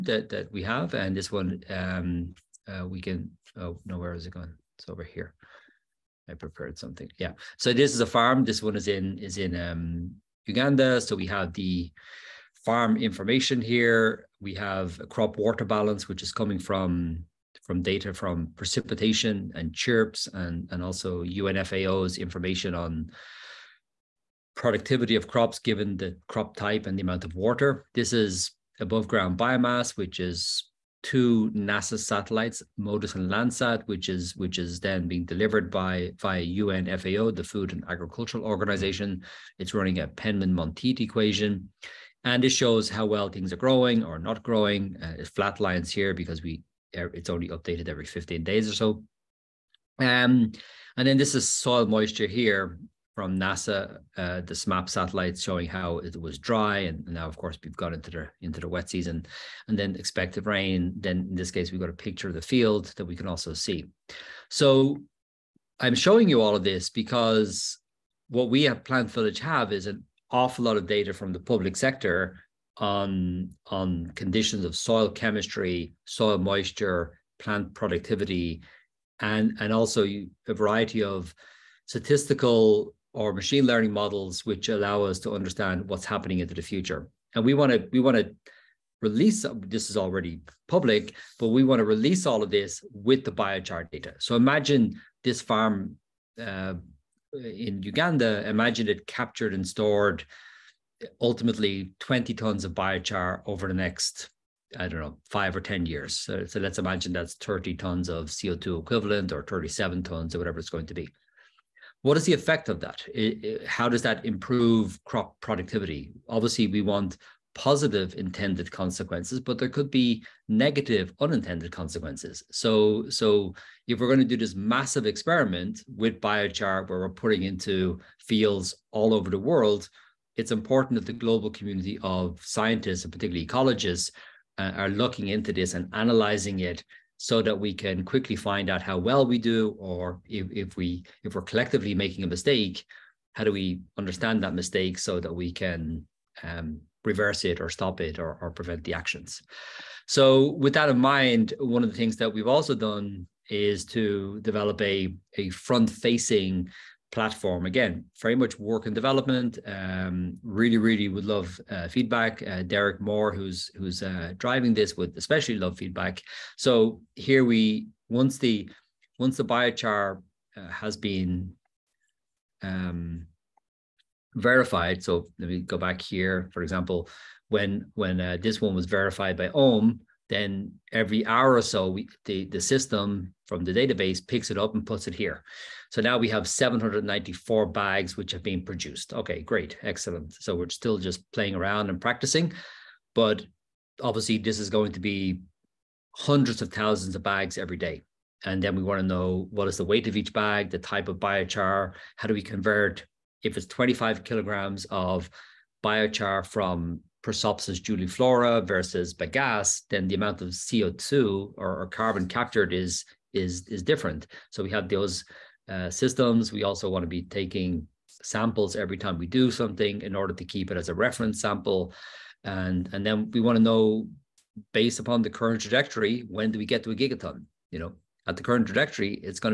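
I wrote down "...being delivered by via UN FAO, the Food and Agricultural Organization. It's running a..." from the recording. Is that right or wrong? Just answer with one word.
right.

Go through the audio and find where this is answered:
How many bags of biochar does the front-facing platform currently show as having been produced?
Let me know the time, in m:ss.
3:06.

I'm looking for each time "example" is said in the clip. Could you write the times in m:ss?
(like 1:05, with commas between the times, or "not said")
2:56.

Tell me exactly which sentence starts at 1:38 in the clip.
Imagine it captured and stored ultimately 20 tons of biochar over the next I don't know, five or 10 years.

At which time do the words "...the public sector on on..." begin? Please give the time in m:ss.
1:11.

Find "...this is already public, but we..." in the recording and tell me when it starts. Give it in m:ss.
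1:29.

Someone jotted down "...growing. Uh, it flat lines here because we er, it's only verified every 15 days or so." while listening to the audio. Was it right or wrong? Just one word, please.
wrong.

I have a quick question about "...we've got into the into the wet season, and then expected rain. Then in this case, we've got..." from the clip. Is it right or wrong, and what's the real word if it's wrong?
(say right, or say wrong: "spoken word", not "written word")
right.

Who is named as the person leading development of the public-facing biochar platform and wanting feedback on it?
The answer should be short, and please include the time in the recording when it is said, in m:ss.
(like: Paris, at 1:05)
Derek Moore, at 2:42.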